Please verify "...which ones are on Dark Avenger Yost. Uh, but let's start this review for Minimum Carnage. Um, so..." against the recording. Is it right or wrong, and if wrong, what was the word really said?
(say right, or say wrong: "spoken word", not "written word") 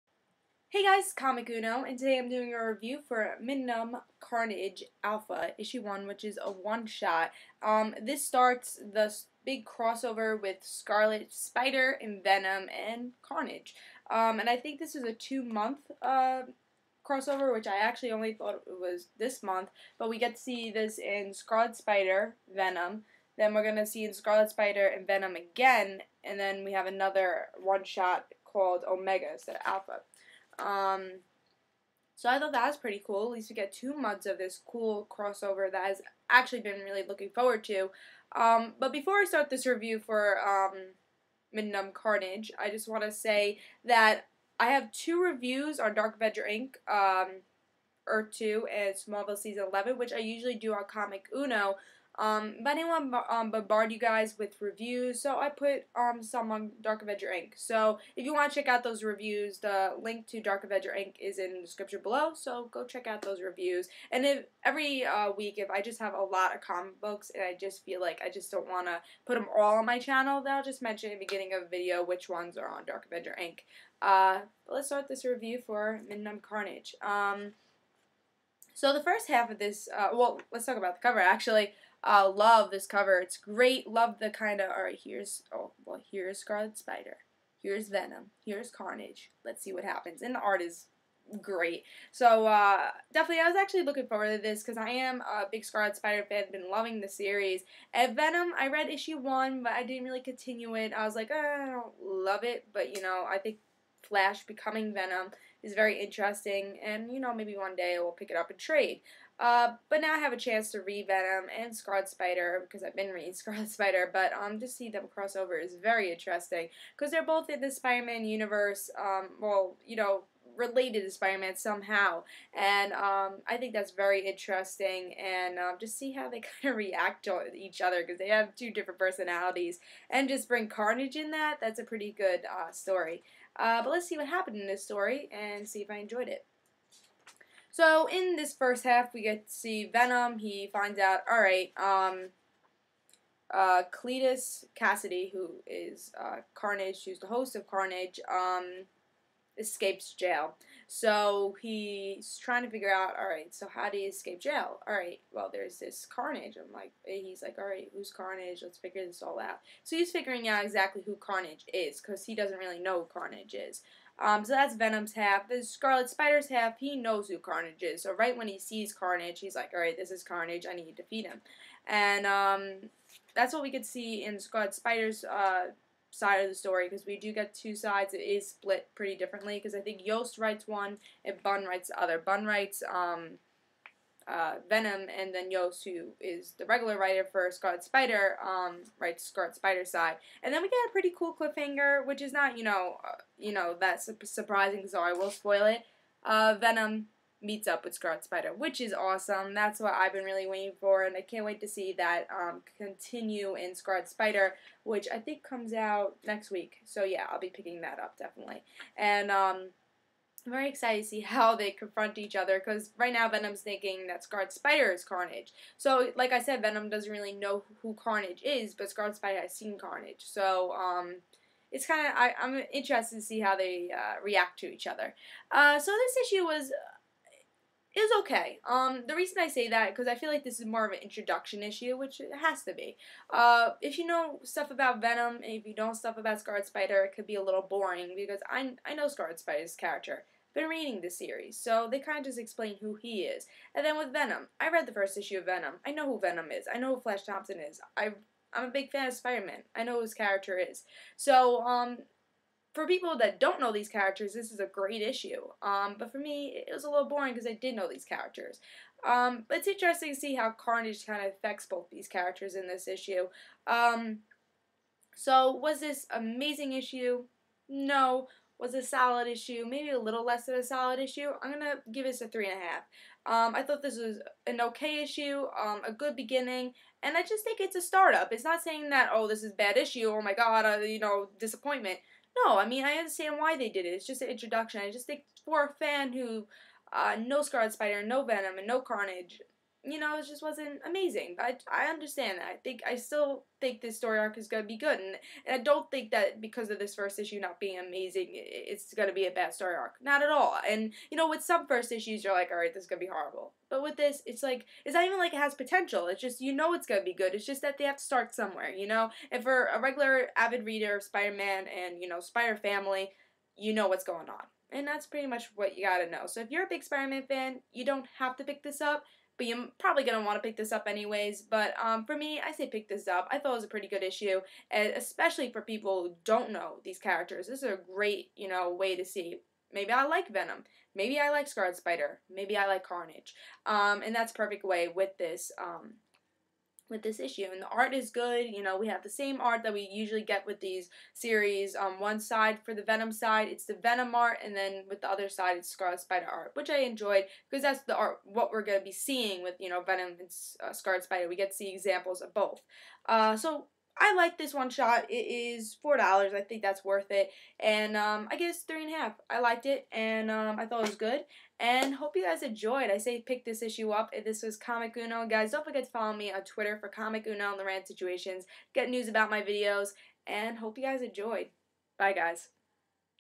wrong: "Inc", not "Yost".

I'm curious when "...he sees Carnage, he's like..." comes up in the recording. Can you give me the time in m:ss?
2:48.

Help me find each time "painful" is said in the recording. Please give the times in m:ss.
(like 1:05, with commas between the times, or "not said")
not said.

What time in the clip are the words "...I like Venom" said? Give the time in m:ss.
5:29.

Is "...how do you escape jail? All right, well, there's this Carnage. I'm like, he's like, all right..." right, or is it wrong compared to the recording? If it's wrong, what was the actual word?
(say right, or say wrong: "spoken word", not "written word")
right.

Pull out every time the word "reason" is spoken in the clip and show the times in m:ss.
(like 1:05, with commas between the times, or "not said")
3:49.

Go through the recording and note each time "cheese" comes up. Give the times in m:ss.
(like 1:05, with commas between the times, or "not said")
not said.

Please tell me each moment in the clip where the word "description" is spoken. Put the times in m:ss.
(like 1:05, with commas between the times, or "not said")
1:01.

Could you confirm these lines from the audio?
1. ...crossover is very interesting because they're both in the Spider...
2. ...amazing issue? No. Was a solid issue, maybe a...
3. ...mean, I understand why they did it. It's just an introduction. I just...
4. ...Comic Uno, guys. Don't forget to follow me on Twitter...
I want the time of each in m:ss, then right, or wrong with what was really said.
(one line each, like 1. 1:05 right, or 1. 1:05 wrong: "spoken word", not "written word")
1. 1:55 right
2. 4:26 right
3. 4:42 right
4. 6:04 right.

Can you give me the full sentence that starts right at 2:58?
It is split pretty differently because I think Yost writes one and Bunn writes the other.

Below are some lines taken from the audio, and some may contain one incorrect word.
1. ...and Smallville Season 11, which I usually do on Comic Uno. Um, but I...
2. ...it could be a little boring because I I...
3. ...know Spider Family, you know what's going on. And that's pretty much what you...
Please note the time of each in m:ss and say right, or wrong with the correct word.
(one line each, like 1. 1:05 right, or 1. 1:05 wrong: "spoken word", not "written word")
1. 0:48 right
2. 3:57 right
3. 5:12 right.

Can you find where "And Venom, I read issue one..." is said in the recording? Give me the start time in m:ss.
1:37.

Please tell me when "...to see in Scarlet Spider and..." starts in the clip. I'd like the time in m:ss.
0:23.